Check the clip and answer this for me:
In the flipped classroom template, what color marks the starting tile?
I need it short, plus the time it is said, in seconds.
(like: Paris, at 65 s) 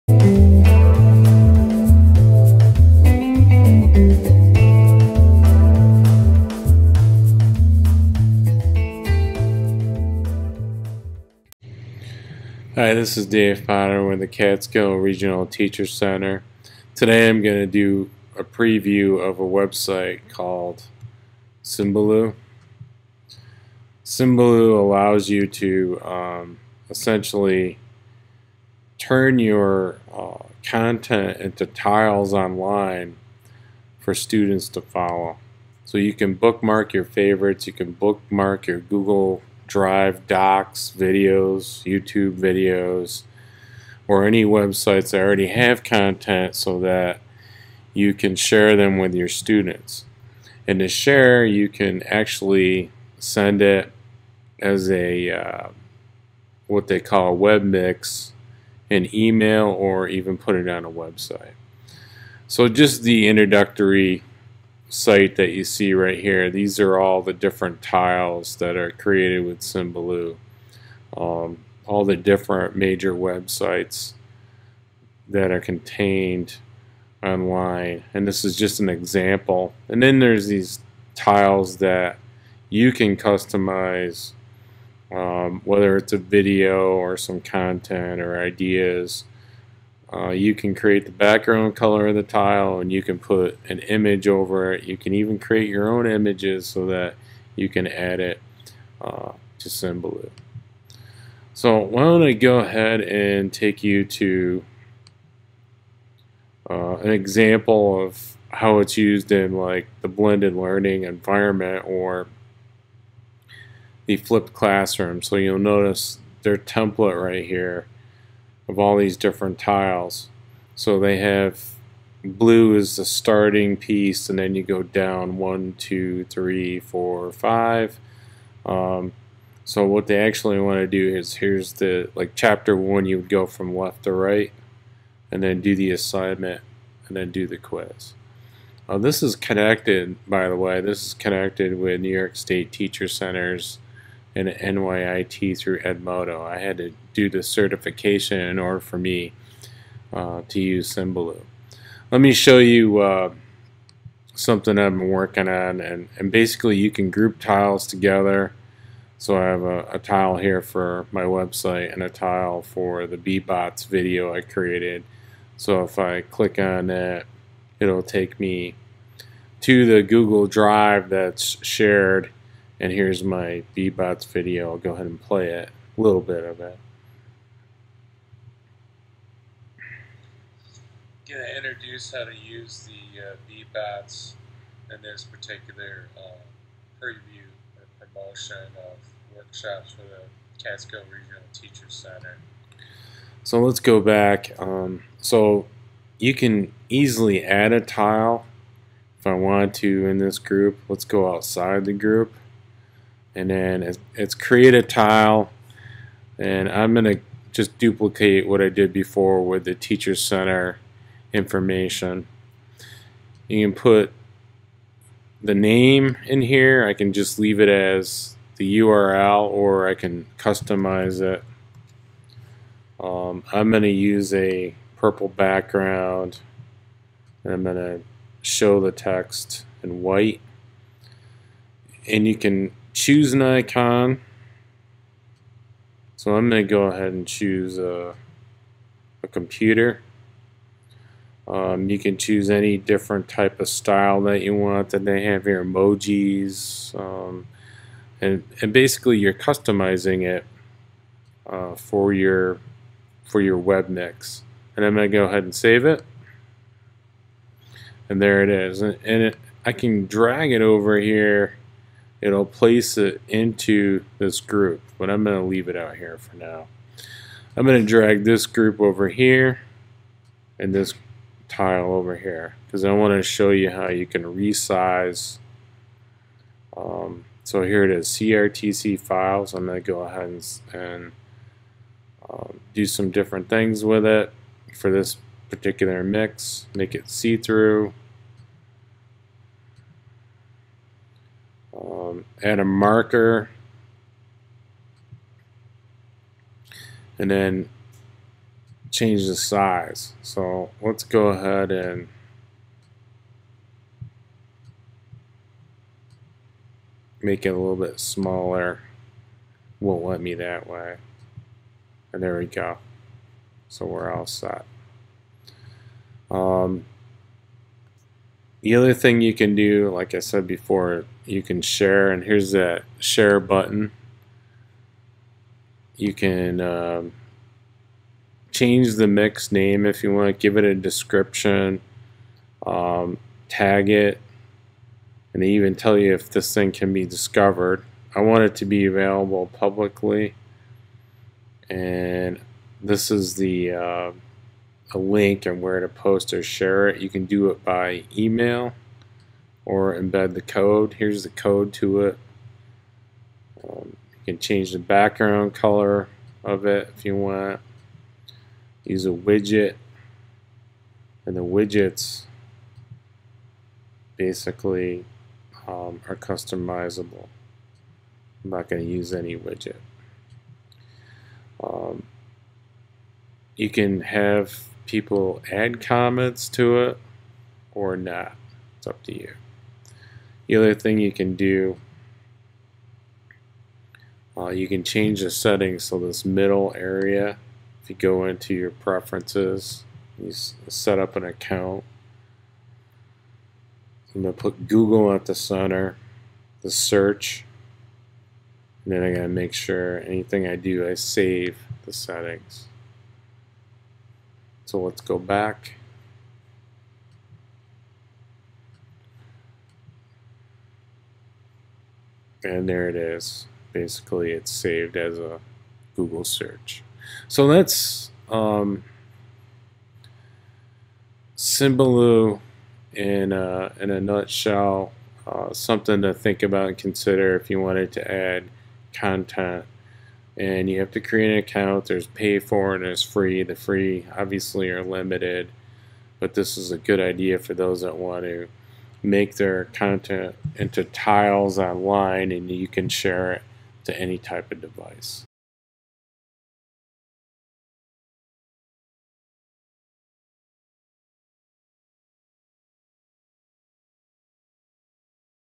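blue, at 122 s.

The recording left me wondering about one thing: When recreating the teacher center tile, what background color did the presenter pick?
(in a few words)
purple.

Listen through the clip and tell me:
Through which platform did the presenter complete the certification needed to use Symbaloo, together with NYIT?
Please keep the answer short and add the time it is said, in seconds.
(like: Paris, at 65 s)
Edmodo, at 145 s.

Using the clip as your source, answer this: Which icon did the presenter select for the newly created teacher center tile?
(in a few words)
a computer.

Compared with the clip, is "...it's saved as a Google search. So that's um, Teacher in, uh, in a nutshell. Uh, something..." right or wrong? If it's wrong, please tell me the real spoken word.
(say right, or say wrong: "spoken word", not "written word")
wrong: "Symbaloo", not "Teacher".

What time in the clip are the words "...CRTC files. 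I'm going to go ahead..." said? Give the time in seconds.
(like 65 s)
278 s.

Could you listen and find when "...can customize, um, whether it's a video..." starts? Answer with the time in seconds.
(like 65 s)
82 s.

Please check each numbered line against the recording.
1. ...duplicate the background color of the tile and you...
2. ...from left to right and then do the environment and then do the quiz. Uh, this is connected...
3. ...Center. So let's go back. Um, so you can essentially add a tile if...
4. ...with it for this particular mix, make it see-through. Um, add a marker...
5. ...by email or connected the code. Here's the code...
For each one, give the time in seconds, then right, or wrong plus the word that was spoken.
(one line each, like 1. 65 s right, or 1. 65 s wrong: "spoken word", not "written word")
1. 90 s wrong: "create", not "duplicate"
2. 133 s wrong: "assignment", not "environment"
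3. 191 s wrong: "easily", not "essentially"
4. 283 s right
5. 347 s wrong: "embed", not "connected".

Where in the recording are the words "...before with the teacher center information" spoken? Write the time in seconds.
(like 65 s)
208 s.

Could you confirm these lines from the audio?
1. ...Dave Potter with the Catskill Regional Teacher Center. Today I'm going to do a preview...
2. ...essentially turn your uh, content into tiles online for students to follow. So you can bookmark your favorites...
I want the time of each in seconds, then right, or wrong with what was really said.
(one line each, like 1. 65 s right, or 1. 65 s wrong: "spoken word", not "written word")
1. 13 s right
2. 26 s right.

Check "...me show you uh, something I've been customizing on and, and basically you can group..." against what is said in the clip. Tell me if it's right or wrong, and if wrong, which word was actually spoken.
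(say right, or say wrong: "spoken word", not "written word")
wrong: "working", not "customizing".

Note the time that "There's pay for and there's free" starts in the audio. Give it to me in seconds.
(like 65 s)
431 s.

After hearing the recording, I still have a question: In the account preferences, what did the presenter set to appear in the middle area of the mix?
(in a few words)
Google search.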